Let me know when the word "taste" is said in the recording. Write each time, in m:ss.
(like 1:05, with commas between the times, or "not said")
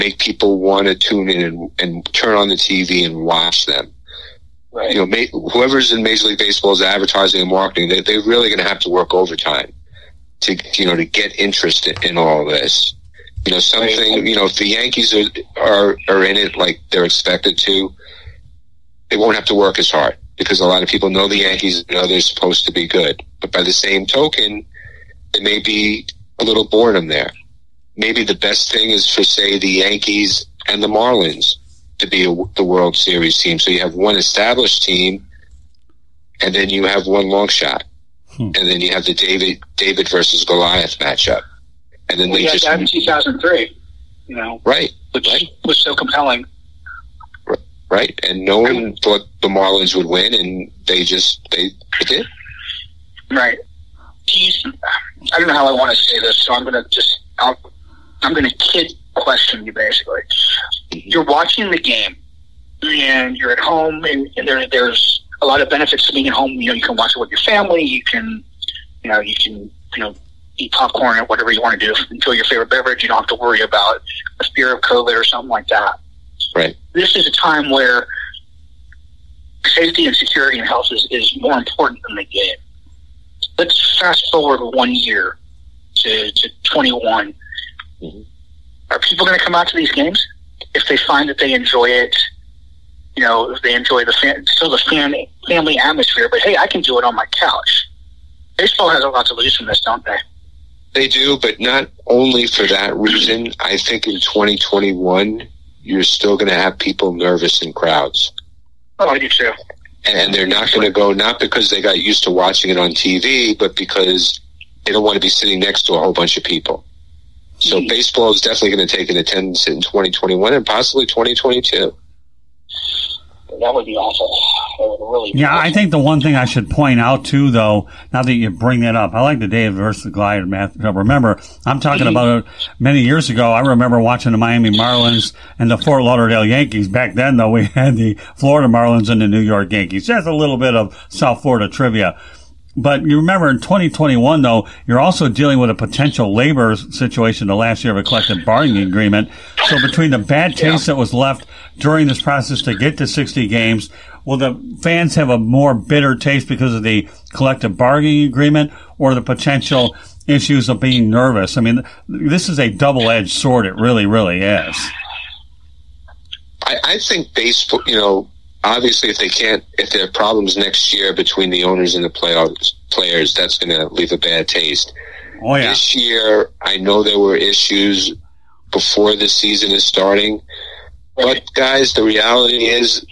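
2:30, 2:36, 2:54.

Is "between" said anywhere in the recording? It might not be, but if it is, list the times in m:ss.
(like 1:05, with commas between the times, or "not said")
2:29, 2:51.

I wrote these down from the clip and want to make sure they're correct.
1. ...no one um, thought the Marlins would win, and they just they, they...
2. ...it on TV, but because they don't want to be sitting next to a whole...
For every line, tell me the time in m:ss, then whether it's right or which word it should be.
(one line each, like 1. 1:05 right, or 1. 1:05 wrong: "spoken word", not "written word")
1. 0:48 right
2. 1:52 right.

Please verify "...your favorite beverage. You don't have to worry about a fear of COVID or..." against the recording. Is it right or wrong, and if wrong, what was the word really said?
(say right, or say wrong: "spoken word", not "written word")
right.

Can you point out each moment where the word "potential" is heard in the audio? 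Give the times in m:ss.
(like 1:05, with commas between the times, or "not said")
2:25, 2:39.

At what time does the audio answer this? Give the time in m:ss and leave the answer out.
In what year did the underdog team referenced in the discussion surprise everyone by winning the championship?
0:42.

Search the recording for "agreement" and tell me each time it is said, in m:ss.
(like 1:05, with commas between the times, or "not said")
2:28, 2:38.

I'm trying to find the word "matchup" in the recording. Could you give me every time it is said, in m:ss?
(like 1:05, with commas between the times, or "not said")
0:40, 2:10.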